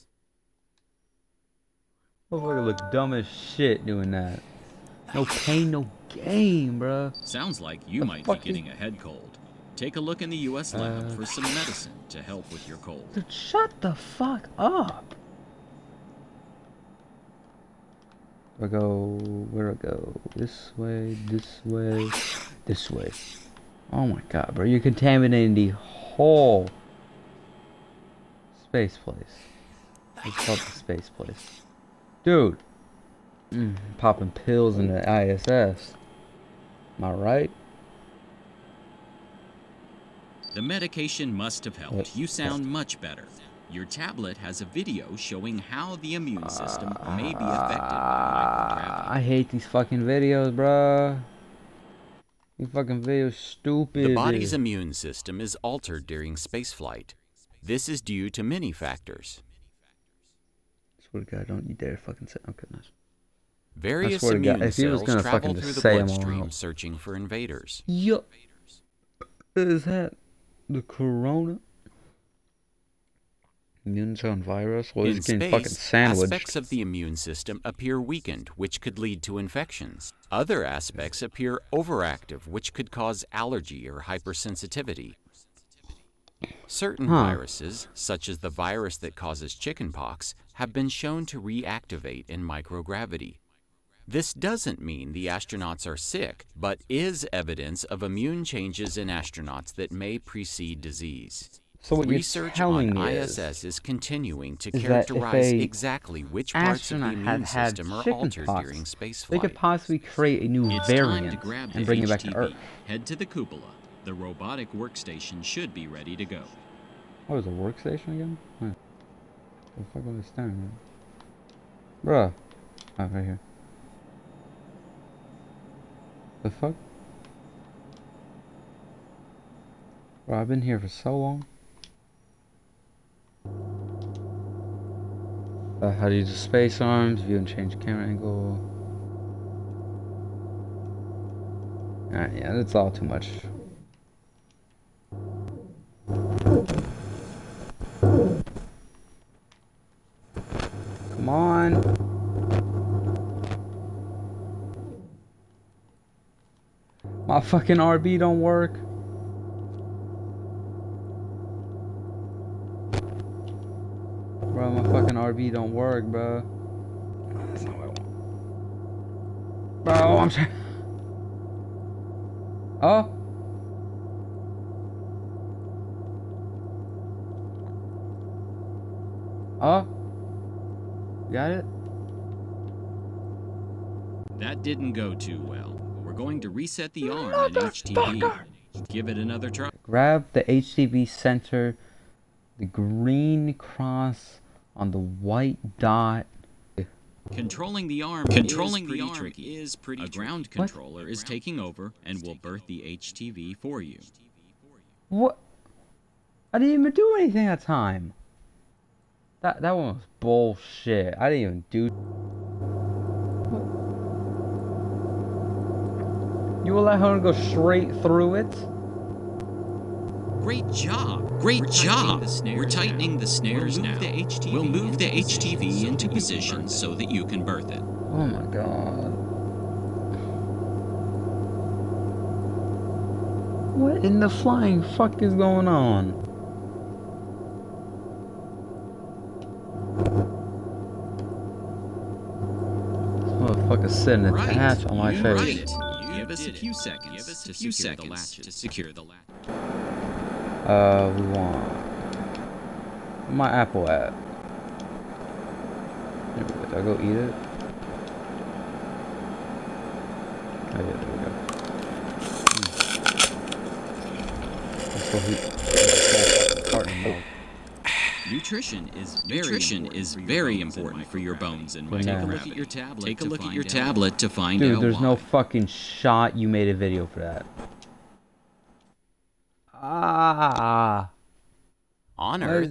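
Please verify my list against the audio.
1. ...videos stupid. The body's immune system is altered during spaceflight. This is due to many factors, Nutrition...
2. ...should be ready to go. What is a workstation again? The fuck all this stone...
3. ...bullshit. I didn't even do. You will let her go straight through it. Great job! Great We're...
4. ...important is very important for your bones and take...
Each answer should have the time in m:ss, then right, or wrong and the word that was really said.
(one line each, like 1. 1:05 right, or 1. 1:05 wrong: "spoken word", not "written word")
1. 0:53 wrong: "Swear", not "Nutrition"
2. 1:55 right
3. 3:30 right
4. 4:29 right.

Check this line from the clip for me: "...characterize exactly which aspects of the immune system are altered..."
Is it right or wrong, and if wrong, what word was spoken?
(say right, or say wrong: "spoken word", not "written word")
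wrong: "parts", not "aspects".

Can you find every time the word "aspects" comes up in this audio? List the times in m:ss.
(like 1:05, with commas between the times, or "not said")
1:15, 1:20.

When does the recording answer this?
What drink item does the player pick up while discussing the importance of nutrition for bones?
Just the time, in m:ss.
4:26.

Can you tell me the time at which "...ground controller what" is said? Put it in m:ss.
3:20.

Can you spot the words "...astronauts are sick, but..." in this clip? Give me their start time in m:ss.
1:35.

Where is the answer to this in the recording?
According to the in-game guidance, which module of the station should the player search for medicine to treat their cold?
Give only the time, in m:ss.
0:10.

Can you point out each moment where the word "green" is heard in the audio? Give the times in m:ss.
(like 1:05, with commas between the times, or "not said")
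3:12.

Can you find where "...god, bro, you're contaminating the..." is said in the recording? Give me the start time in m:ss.
0:24.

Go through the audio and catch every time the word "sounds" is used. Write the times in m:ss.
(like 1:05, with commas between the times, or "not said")
0:07, 0:42.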